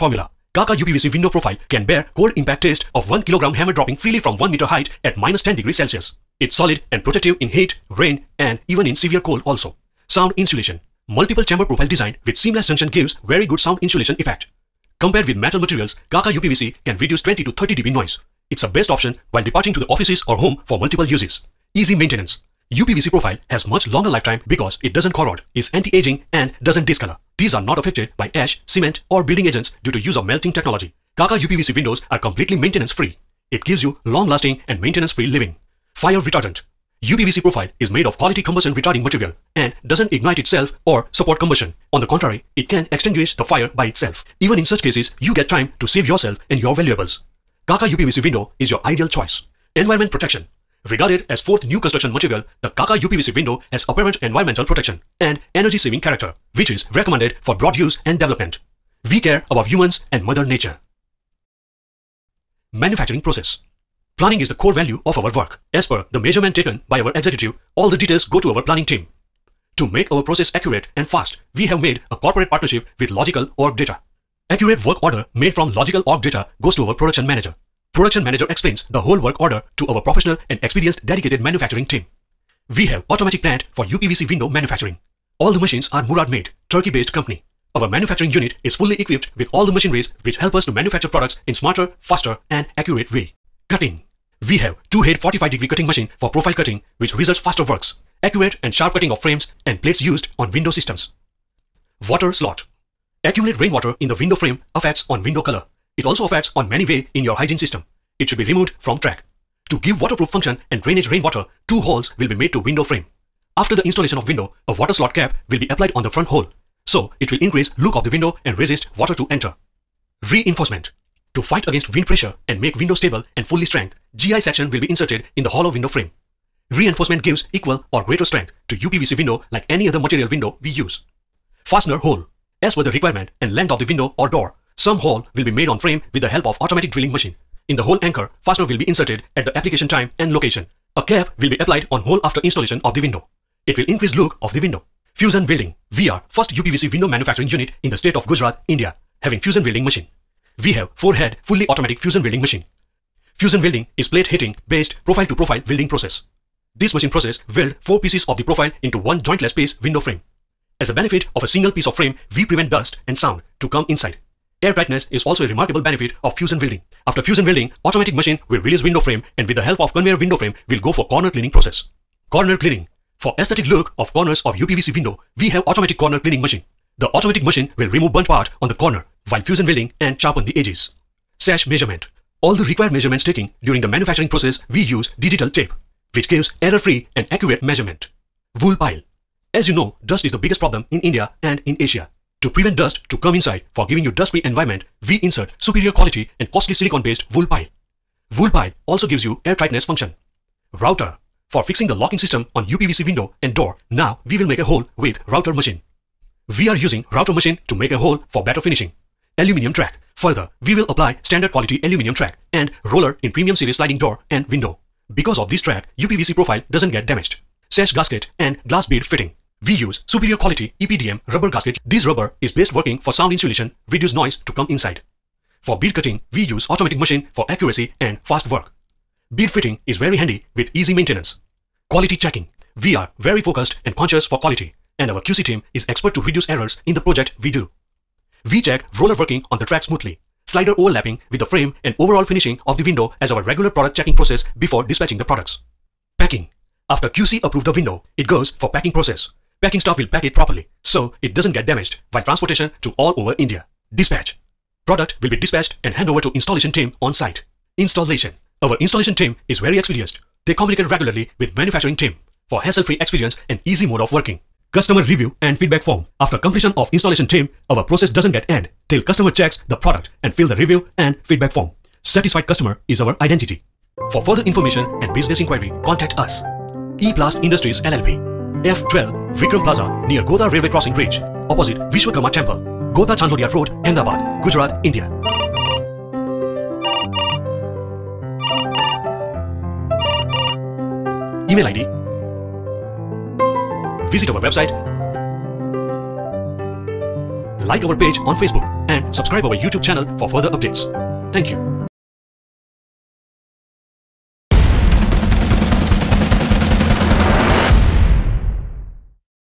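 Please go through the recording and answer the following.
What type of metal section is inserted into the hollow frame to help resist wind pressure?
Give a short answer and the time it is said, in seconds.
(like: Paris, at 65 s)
GI section, at 124 s.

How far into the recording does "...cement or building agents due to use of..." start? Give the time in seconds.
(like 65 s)
28 s.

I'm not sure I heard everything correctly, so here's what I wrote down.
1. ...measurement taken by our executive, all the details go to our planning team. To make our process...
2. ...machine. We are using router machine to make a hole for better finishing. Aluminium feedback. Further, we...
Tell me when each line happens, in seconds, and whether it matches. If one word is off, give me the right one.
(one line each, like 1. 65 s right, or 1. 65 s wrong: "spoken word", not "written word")
1. 66 s right
2. 205 s wrong: "track", not "feedback".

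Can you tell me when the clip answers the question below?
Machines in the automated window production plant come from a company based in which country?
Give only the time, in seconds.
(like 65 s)
86 s.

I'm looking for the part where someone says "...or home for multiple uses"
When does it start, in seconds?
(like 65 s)
20 s.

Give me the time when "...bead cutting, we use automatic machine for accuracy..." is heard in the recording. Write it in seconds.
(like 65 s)
225 s.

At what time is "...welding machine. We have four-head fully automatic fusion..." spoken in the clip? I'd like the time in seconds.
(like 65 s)
149 s.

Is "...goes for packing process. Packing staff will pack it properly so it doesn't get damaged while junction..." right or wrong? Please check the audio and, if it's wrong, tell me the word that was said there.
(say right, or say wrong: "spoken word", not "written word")
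wrong: "transportation", not "junction".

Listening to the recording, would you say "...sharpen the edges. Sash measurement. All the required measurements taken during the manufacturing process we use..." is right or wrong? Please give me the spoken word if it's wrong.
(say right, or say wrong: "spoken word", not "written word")
right.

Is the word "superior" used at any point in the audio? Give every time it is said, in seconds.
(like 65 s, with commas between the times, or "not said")
195 s, 220 s.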